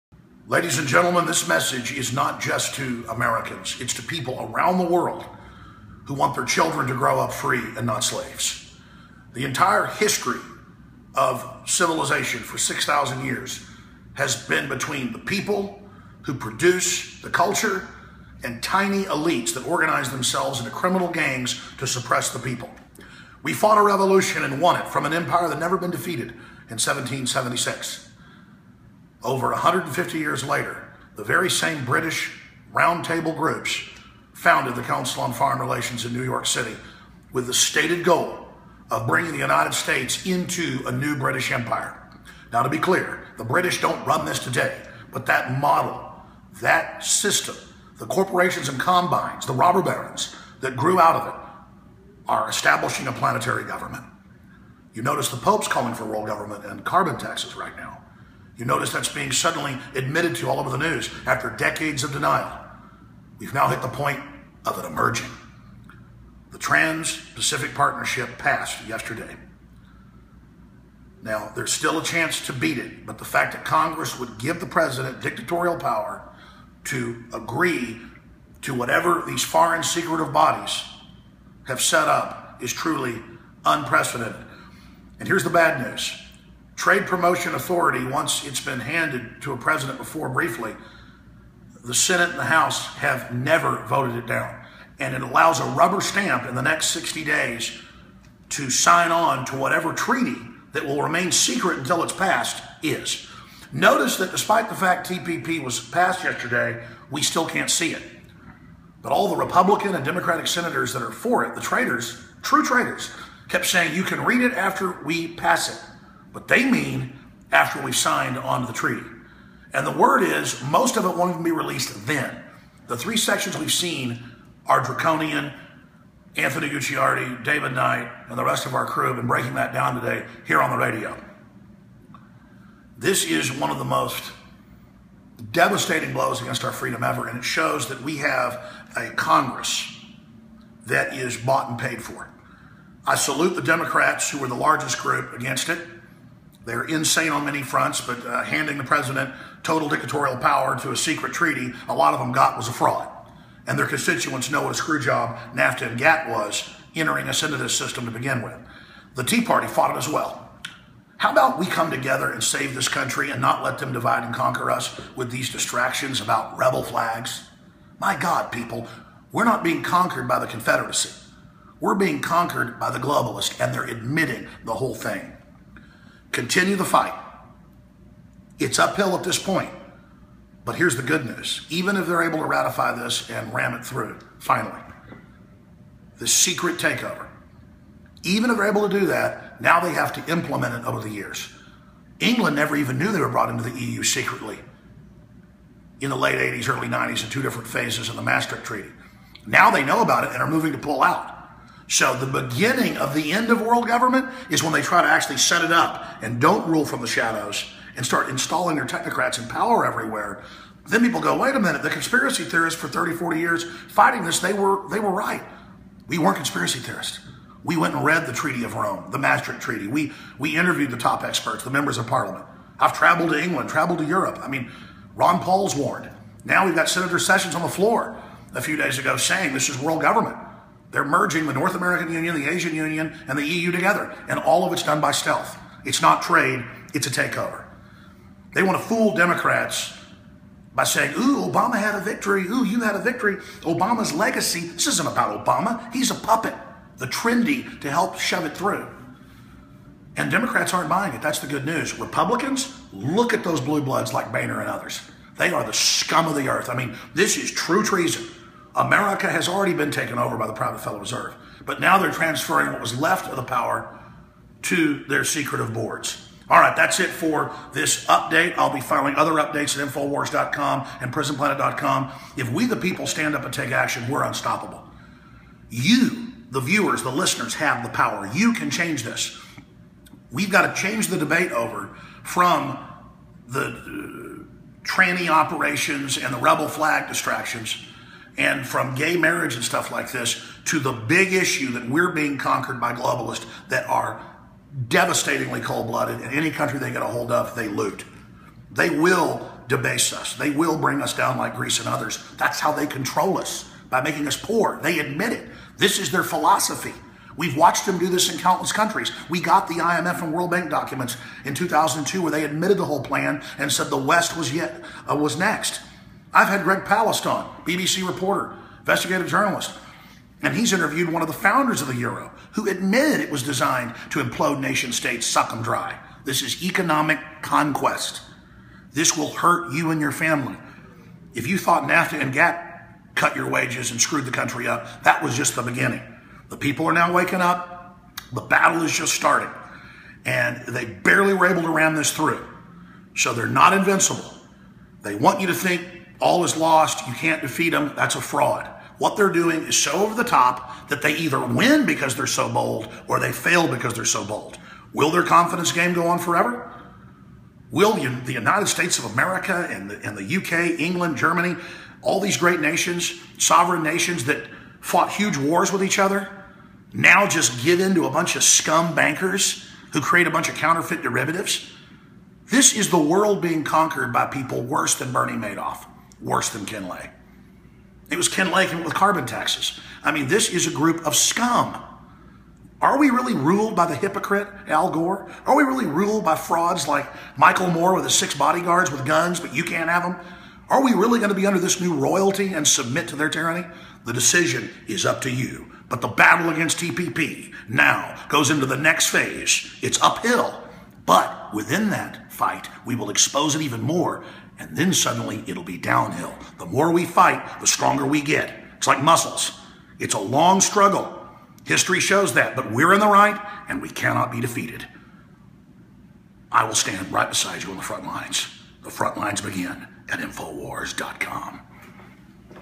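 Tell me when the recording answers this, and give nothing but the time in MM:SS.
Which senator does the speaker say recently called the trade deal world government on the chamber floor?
03:46.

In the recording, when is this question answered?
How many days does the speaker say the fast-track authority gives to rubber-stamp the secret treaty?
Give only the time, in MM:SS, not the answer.
01:36.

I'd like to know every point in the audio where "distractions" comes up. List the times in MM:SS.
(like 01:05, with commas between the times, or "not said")
02:45, 04:47.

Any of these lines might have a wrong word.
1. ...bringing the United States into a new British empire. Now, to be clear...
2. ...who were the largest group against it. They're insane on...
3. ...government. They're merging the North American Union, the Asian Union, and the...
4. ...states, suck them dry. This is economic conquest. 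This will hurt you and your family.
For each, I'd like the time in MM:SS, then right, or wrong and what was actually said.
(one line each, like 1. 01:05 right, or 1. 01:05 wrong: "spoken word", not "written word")
1. 00:39 right
2. 02:24 right
3. 03:50 right
4. 05:24 right.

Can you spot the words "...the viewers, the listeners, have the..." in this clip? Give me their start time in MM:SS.
04:36.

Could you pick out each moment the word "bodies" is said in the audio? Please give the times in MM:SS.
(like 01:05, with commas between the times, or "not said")
01:20.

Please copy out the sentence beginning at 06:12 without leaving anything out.
This is the world being conquered by people worse than Bernie Madoff worse than Ken Lay.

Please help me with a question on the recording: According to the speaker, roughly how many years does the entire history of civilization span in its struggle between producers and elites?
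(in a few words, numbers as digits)
6,000.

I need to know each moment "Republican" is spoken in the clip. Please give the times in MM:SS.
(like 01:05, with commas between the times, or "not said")
01:49, 04:11.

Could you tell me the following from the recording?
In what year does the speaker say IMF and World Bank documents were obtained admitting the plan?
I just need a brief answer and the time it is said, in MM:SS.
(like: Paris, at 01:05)
2002, at 05:11.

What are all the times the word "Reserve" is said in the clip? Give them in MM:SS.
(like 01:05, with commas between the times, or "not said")
04:21.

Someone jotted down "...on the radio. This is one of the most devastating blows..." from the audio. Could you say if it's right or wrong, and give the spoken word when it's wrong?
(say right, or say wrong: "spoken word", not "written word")
right.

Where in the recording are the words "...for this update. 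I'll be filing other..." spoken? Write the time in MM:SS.
04:27.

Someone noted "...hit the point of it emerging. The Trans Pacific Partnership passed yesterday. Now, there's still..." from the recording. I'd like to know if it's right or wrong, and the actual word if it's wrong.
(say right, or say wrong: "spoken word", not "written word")
right.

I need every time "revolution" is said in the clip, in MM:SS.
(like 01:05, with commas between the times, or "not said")
00:23.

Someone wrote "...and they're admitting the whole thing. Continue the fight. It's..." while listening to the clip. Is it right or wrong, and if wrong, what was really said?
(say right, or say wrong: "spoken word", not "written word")
right.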